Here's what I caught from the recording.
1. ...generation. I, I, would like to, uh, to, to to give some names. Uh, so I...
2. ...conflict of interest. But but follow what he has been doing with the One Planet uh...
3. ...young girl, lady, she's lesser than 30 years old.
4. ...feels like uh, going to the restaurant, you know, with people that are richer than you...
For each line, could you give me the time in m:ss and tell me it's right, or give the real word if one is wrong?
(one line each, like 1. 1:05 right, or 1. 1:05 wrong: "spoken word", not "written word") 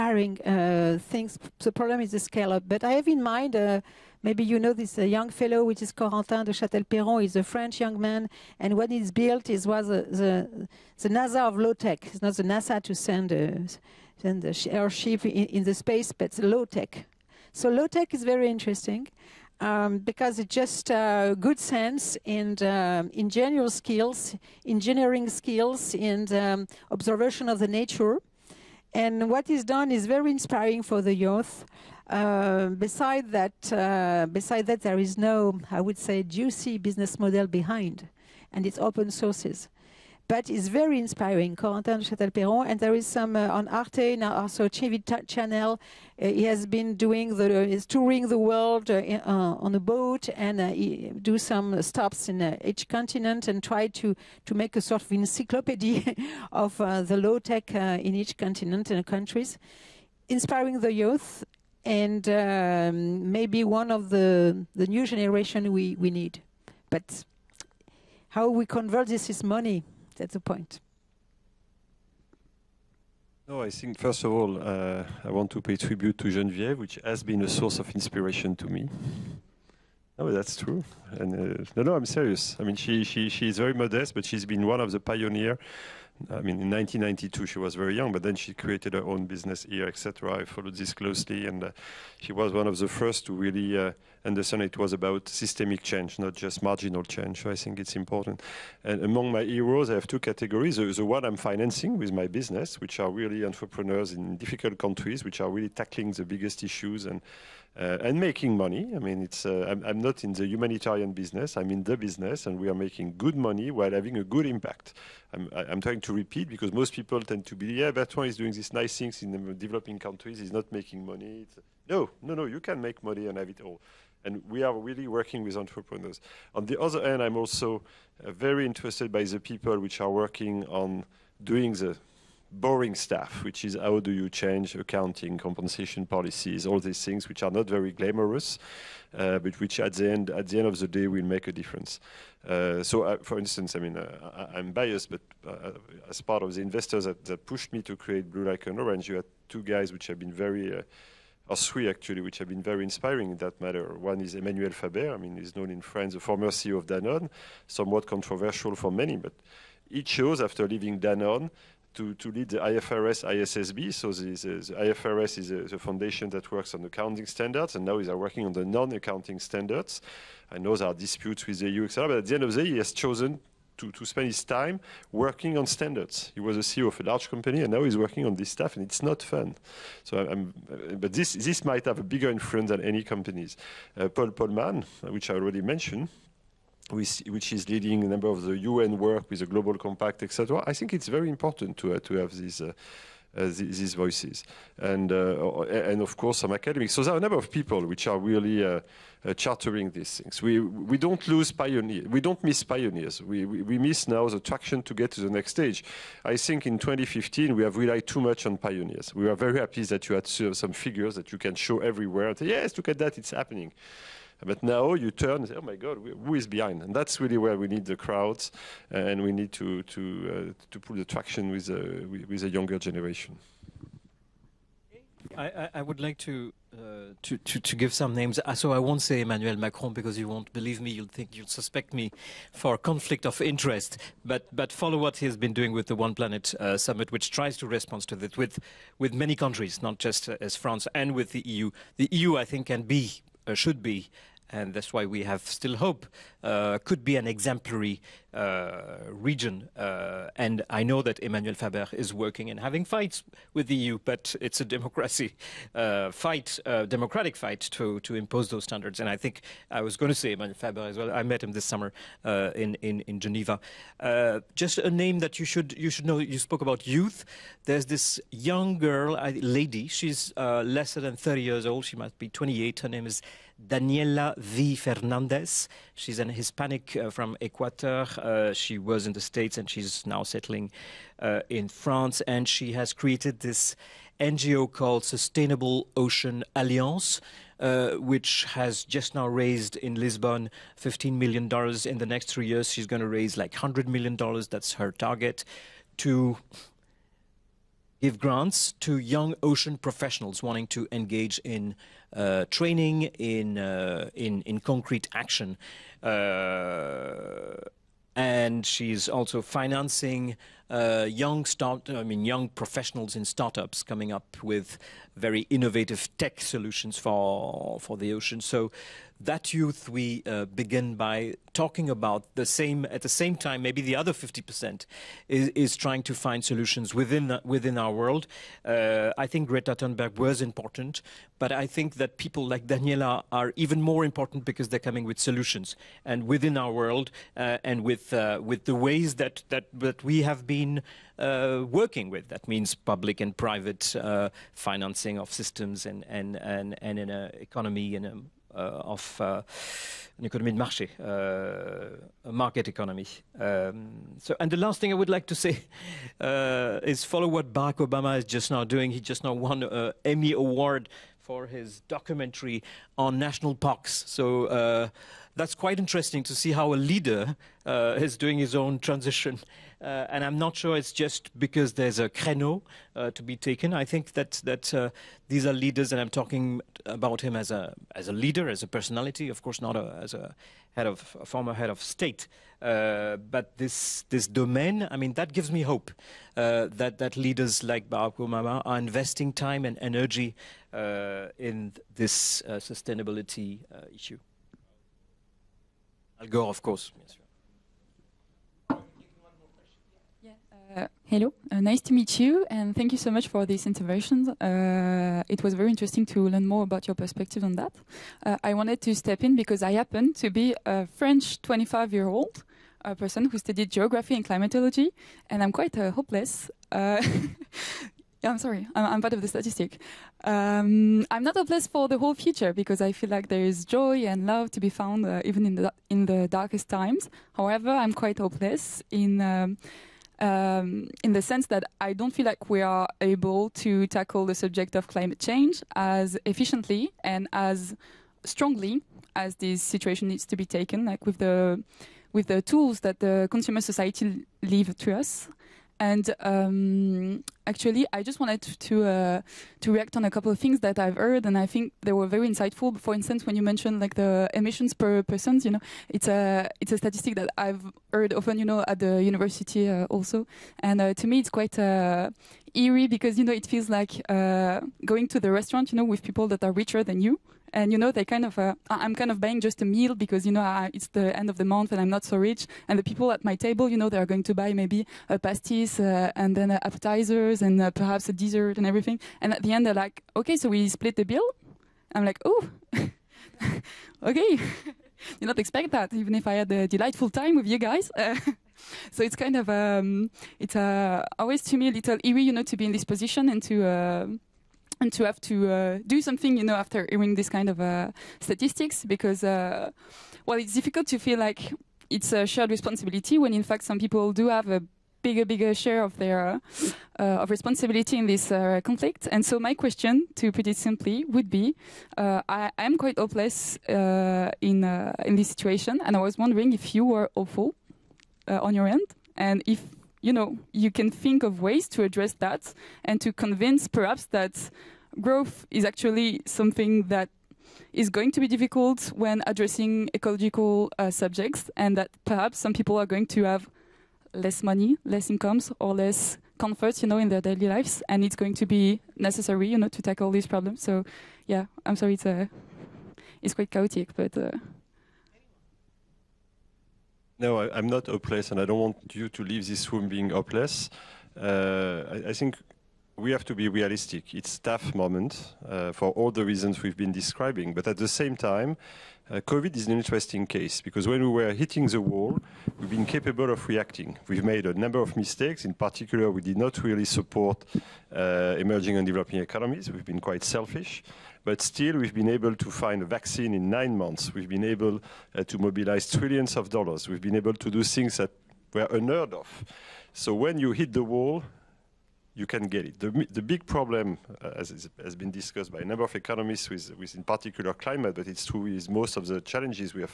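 1. 3:42 right
2. 3:52 right
3. 4:28 right
4. 7:43 right.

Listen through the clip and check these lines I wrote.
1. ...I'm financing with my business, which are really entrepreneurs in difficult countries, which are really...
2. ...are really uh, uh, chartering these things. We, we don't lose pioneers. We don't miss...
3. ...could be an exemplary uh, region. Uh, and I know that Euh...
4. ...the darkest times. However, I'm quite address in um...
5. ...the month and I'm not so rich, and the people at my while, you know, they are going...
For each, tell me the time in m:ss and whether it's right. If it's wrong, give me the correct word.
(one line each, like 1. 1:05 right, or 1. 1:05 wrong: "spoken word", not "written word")
1. 1:41 right
2. 3:18 right
3. 4:06 wrong: "Emmanuel", not "Euh"
4. 7:06 wrong: "hopeless", not "address"
5. 7:51 wrong: "table", not "while".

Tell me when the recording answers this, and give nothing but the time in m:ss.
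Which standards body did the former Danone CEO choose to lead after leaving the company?
2:42.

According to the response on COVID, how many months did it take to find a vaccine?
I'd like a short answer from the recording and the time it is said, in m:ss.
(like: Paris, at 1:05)
9, at 9:33.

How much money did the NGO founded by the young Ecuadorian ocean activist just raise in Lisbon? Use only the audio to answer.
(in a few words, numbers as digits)
$15 million.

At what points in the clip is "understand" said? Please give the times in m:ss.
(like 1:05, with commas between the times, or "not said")
1:34.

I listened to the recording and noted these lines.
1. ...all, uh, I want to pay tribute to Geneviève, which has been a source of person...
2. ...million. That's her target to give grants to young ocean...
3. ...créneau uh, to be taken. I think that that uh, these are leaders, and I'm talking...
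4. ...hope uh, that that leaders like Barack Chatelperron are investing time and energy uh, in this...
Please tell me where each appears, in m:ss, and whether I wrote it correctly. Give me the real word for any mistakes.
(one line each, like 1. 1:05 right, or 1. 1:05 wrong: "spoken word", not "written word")
1. 1:14 wrong: "inspiration", not "person"
2. 4:53 right
3. 6:12 right
4. 6:25 wrong: "Obama", not "Chatelperron".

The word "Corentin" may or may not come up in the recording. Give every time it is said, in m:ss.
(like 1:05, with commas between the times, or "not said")
0:05, 0:41.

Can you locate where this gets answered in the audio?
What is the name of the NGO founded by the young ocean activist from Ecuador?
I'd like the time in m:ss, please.
4:45.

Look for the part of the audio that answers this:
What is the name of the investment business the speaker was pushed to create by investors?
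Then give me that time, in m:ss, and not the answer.
2:28.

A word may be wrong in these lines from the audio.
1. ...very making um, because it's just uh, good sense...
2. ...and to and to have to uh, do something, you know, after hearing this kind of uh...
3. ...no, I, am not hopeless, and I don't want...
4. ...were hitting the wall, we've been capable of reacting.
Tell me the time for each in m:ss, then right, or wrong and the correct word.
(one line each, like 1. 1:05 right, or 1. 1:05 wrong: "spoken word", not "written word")
1. 0:18 wrong: "interesting", not "making"
2. 8:13 right
3. 9:07 right
4. 9:21 right.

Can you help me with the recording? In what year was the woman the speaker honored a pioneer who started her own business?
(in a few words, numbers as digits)
1992.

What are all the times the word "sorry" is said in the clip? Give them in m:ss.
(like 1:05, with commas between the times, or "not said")
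6:58, 9:01.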